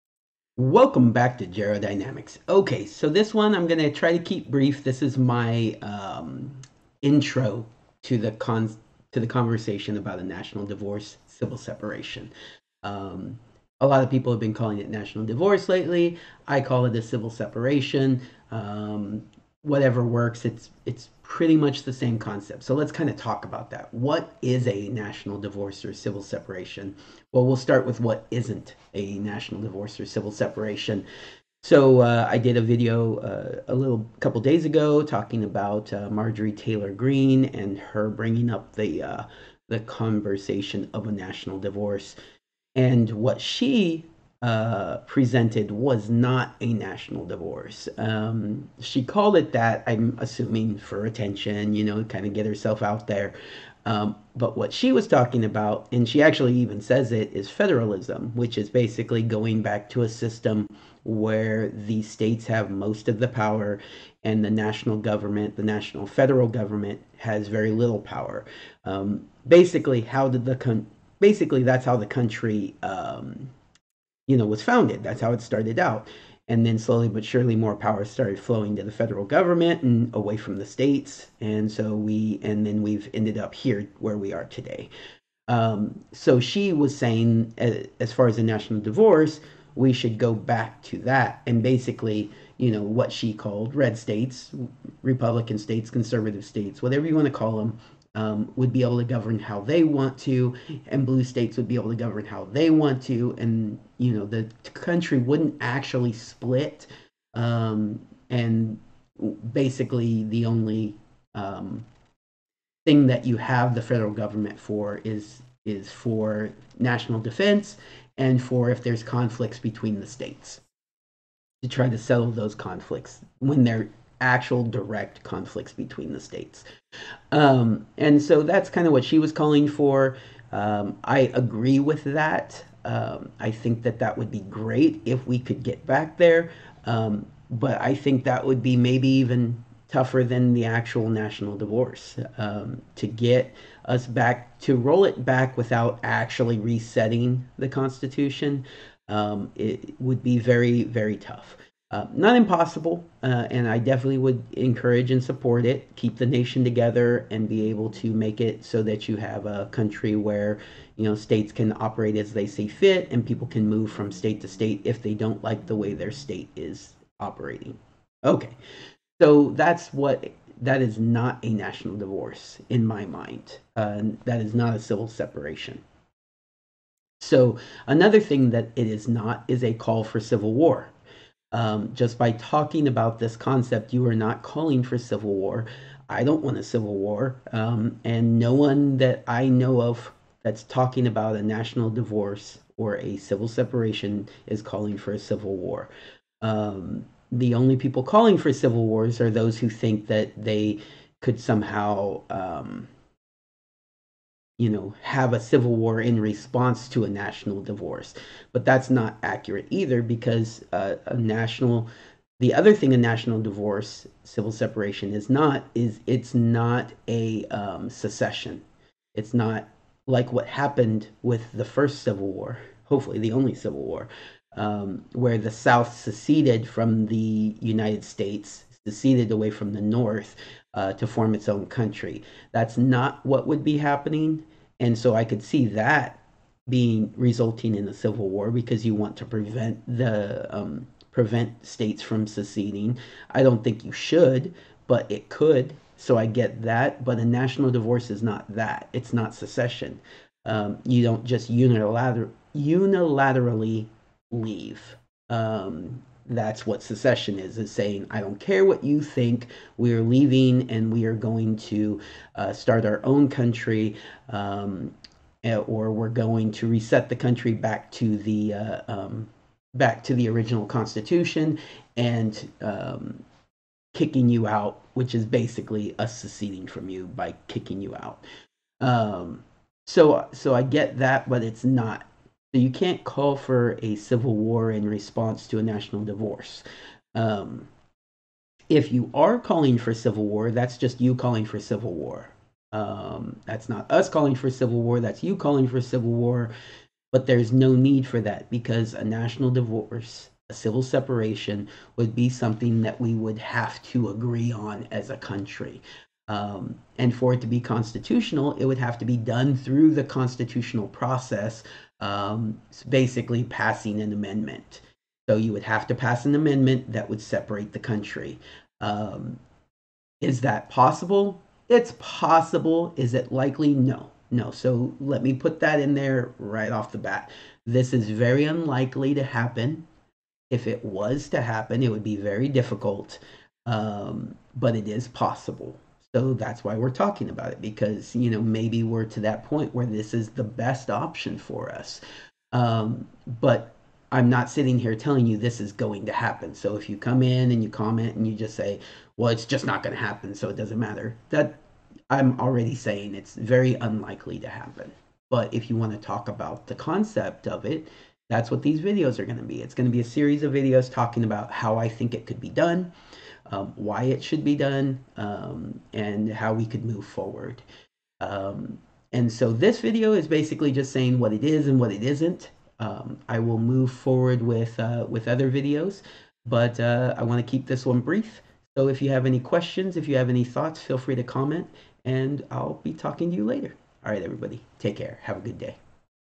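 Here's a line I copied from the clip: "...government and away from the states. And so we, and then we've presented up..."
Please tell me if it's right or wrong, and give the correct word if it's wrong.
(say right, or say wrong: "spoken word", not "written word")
wrong: "ended", not "presented".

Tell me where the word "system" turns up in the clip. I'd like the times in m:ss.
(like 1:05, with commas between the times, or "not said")
1:00.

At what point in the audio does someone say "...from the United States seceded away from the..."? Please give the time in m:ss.
3:46.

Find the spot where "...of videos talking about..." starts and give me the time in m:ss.
6:00.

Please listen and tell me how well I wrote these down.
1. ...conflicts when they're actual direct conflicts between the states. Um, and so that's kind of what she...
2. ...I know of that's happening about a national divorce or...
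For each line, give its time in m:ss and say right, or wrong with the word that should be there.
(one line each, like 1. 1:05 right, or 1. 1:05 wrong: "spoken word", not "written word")
1. 2:02 right
2. 3:09 wrong: "talking", not "happening".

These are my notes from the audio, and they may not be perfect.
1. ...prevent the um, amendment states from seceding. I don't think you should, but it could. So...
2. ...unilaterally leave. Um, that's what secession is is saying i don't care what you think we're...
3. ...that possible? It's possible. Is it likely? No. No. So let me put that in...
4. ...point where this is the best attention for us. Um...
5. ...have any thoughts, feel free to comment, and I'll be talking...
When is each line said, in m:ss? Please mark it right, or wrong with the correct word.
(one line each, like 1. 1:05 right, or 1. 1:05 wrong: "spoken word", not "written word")
1. 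3:59 wrong: "prevent", not "amendment"
2. 4:12 right
3. 5:20 right
4. 5:39 wrong: "option", not "attention"
5. 6:20 right.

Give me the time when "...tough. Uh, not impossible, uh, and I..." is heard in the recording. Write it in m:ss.
2:31.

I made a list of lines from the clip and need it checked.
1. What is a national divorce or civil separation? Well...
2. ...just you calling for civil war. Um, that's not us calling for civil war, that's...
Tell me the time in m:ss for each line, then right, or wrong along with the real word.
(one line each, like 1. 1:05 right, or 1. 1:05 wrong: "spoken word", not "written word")
1. 0:23 right
2. 4:50 right.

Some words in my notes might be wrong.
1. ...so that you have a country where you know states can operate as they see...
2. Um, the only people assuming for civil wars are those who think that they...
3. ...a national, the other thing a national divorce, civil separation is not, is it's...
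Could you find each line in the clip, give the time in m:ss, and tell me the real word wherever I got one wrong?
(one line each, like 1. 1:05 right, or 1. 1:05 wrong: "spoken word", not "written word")
1. 2:38 right
2. 3:16 wrong: "calling", not "assuming"
3. 3:31 right.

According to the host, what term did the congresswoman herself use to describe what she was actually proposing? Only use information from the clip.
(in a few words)
federalism.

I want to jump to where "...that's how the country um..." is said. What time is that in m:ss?
1:11.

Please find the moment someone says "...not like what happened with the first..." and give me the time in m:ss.
3:39.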